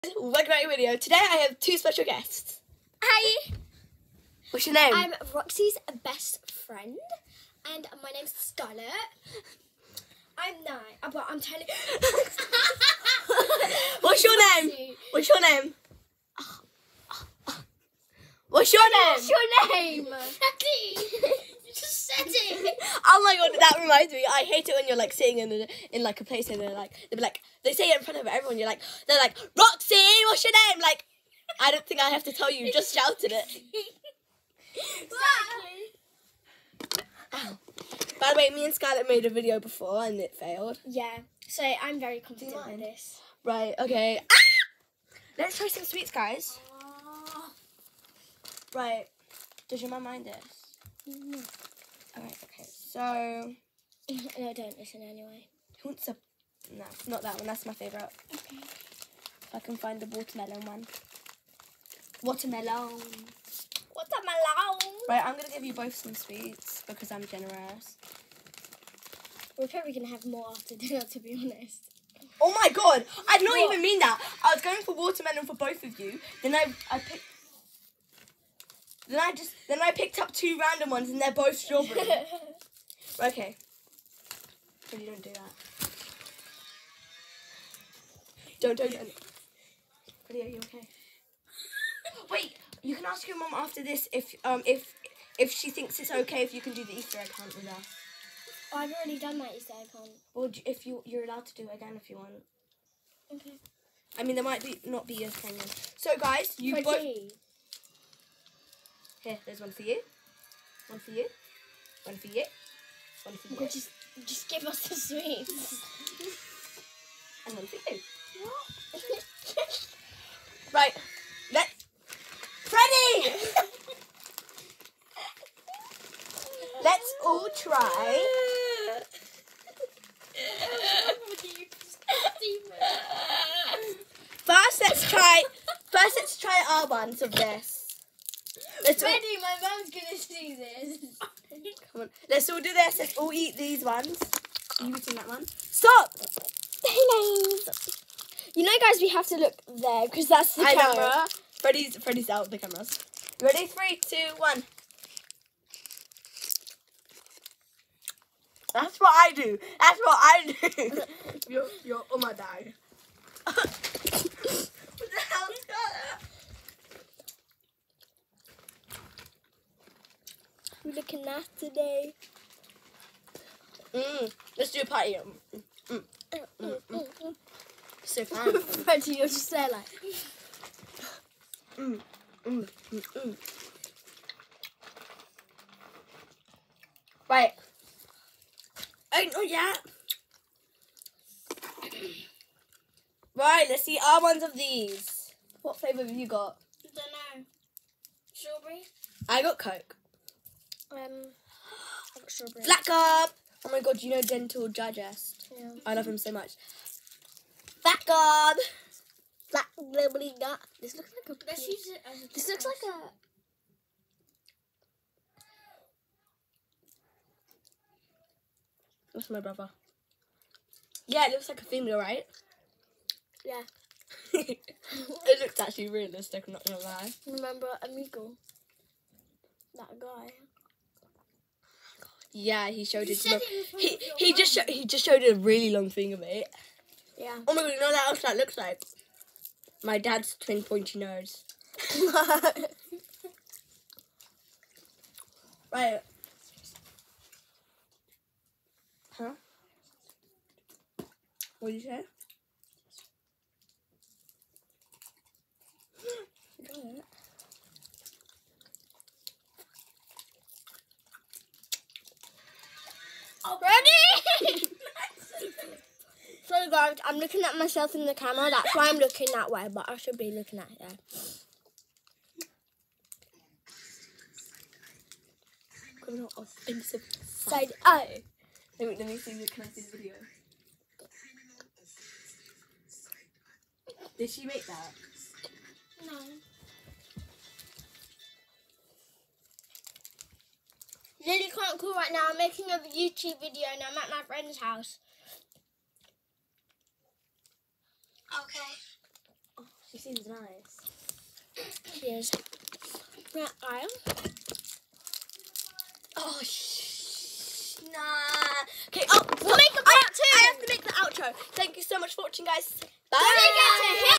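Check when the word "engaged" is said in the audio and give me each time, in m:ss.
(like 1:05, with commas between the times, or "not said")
not said.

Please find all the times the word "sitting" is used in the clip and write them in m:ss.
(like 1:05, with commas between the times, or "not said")
0:25.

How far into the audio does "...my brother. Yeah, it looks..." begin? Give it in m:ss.
3:39.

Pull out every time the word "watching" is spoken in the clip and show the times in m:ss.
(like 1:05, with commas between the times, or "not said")
5:12.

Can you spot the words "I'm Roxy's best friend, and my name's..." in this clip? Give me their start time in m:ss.
0:04.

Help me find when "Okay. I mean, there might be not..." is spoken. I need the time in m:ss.
1:43.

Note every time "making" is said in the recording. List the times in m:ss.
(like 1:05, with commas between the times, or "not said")
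4:52.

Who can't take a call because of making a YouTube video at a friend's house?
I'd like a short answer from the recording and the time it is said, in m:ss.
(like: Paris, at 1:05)
Lily, at 4:51.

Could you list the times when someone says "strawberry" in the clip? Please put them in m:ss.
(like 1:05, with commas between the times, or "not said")
1:21, 3:18.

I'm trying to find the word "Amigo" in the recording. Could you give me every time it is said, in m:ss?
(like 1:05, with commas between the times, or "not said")
3:47.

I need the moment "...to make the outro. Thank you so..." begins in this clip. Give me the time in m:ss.
5:10.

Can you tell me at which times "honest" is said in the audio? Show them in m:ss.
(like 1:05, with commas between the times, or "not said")
1:11.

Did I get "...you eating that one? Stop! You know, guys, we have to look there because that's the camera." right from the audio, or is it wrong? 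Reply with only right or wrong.
right.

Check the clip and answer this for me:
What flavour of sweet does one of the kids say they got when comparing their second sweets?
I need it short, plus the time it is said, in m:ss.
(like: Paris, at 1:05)
Coke, at 3:19.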